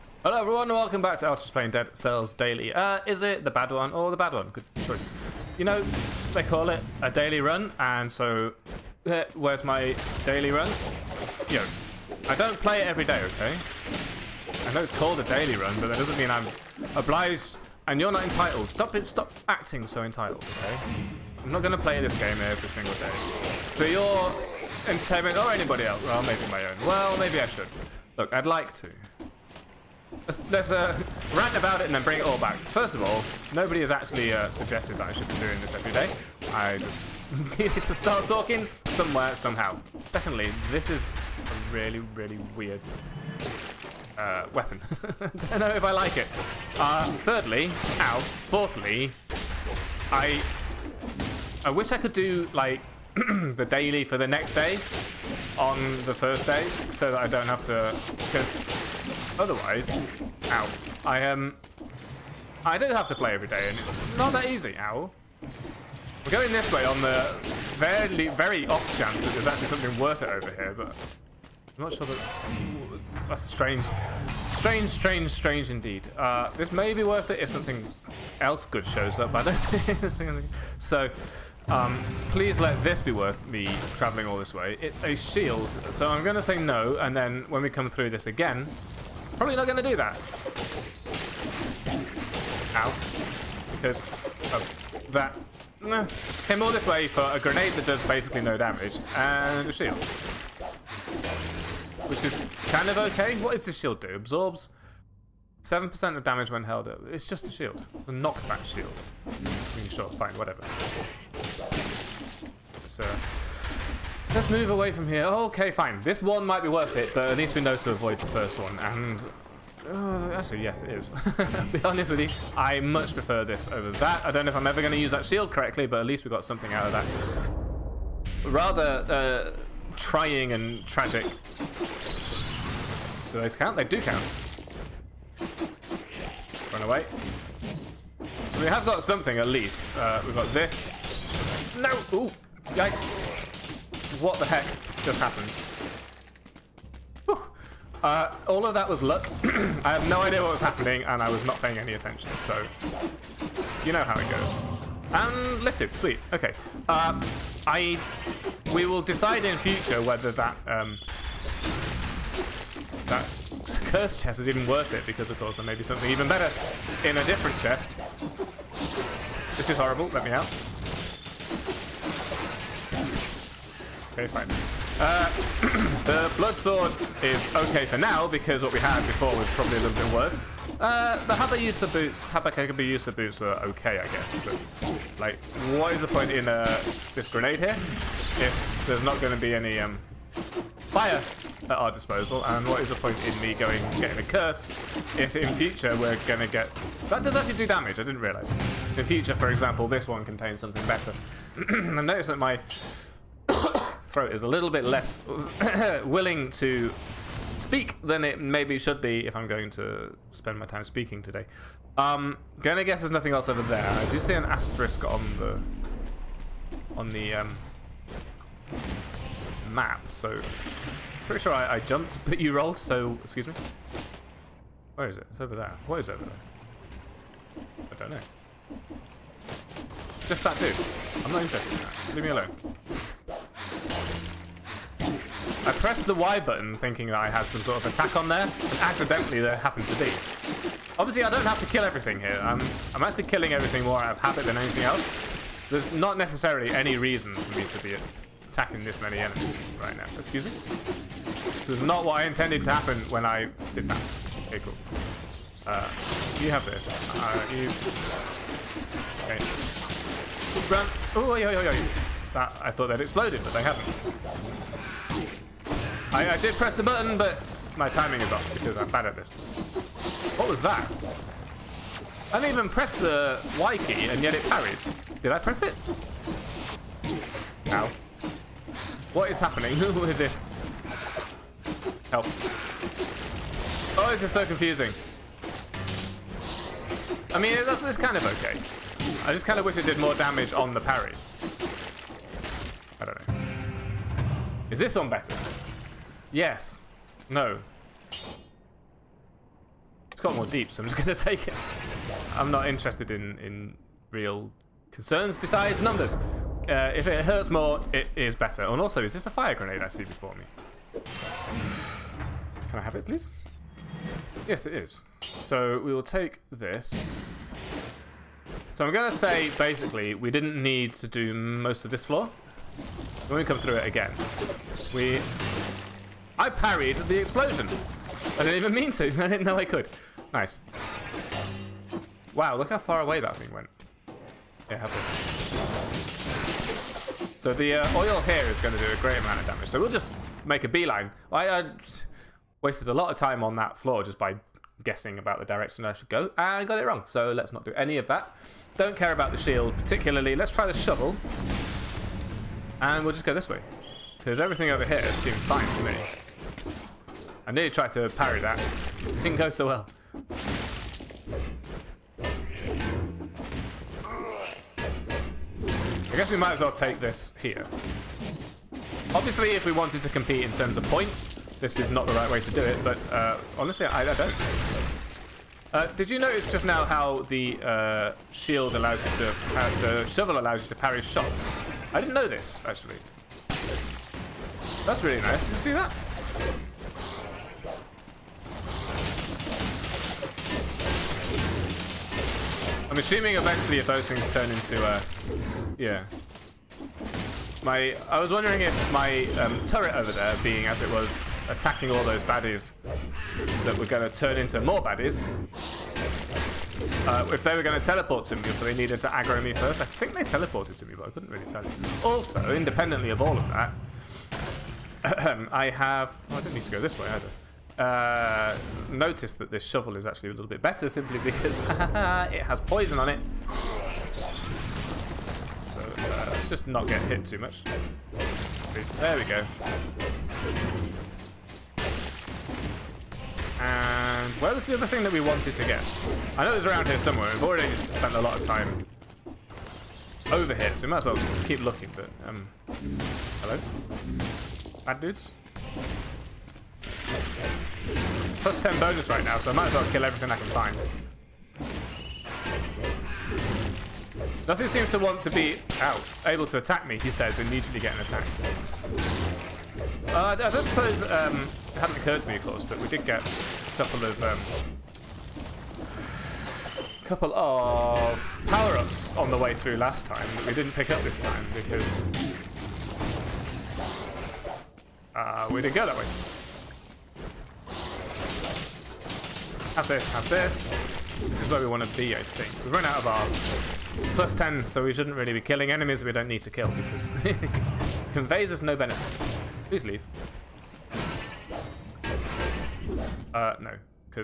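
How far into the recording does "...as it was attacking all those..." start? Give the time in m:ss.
6:40.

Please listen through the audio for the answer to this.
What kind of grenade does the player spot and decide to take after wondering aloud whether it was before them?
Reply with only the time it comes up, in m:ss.
5:09.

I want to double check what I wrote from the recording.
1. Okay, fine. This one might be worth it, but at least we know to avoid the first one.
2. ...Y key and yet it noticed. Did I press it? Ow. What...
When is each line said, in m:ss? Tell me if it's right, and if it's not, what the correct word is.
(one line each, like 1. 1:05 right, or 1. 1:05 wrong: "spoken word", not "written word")
1. 1:55 right
2. 4:33 wrong: "parried", not "noticed".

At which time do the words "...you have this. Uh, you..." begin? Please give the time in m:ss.
4:16.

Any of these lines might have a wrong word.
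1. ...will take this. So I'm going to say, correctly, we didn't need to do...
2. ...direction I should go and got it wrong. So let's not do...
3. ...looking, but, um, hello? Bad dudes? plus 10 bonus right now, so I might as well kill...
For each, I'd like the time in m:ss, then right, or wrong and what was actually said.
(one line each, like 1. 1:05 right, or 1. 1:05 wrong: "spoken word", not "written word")
1. 5:15 wrong: "basically", not "correctly"
2. 5:45 right
3. 7:21 right.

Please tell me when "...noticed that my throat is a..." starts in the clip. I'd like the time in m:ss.
3:22.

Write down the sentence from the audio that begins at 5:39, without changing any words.
So we'll just make a beeline.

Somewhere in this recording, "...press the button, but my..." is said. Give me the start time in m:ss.
4:26.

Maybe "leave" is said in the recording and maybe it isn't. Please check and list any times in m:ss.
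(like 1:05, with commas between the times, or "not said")
3:52, 8:09.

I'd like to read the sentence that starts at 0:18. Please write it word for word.
Stop, stop acting so entitled, okay?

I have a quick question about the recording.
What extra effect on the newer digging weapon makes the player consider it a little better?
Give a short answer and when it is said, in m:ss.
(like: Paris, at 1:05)
poison, at 7:02.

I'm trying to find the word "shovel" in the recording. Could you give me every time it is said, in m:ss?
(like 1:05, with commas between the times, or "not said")
5:50, 6:20, 6:59.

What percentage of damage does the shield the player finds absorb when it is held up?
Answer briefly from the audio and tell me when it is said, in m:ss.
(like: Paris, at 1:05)
7%, at 1:45.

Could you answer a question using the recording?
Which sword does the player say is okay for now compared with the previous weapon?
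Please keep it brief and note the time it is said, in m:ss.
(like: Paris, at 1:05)
blood sword, at 2:56.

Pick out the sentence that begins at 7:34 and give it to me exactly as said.
Nothing seems to want to be out, able to attack me, he says, immediately getting attacked.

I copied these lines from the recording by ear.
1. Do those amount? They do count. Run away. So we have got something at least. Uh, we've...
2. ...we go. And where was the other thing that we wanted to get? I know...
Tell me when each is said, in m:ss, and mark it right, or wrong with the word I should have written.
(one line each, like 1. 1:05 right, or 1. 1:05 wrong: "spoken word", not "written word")
1. 2:13 wrong: "count", not "amount"
2. 7:09 right.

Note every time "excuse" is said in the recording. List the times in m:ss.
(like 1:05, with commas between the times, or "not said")
3:43, 4:10.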